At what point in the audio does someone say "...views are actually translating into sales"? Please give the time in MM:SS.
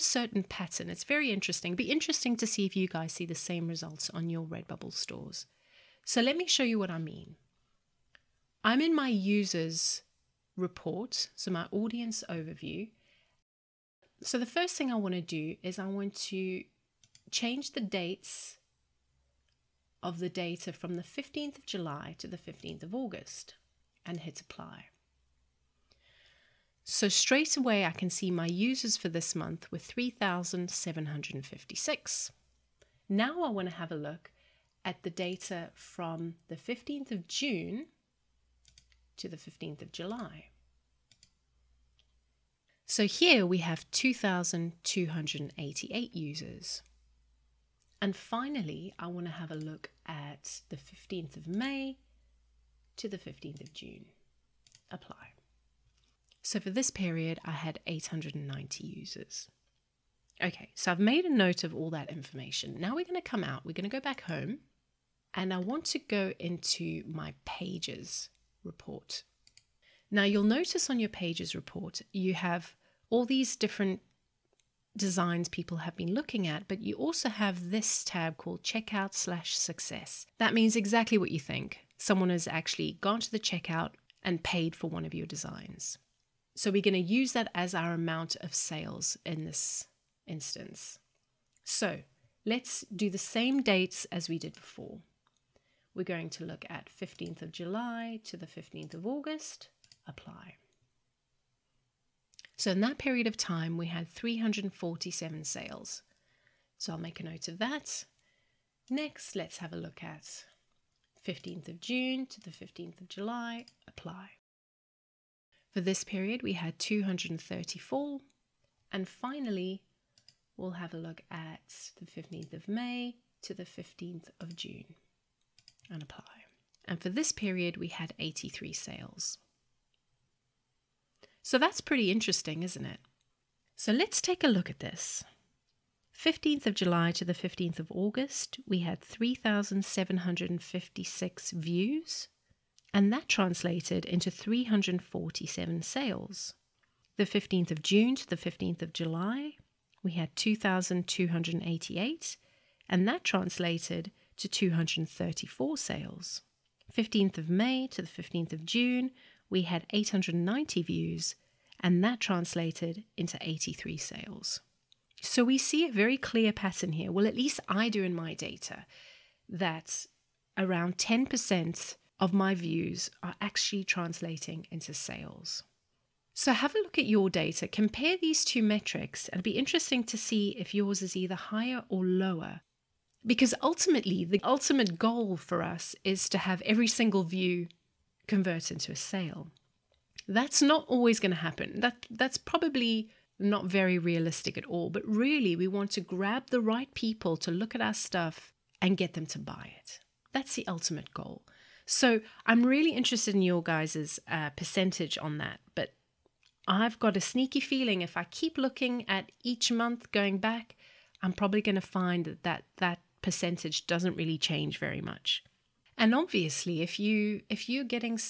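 02:52.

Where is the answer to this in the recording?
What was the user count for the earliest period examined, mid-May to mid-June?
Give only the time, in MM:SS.
00:57.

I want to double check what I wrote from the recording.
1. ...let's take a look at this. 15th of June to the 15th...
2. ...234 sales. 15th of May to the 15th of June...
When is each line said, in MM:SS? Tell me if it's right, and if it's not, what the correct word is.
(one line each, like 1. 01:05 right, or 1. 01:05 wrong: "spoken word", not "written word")
1. 02:13 wrong: "July", not "June"
2. 02:34 right.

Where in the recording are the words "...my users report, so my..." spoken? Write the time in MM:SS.
00:08.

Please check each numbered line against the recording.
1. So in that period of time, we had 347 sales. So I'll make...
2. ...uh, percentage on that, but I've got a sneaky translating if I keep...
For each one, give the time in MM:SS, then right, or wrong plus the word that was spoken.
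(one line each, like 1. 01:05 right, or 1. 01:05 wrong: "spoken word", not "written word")
1. 01:42 right
2. 03:24 wrong: "feeling", not "translating".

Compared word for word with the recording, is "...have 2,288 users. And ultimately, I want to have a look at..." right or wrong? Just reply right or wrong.
wrong.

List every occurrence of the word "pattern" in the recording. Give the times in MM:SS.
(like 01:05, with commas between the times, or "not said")
00:00, 02:46.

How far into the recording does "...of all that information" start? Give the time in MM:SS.
01:01.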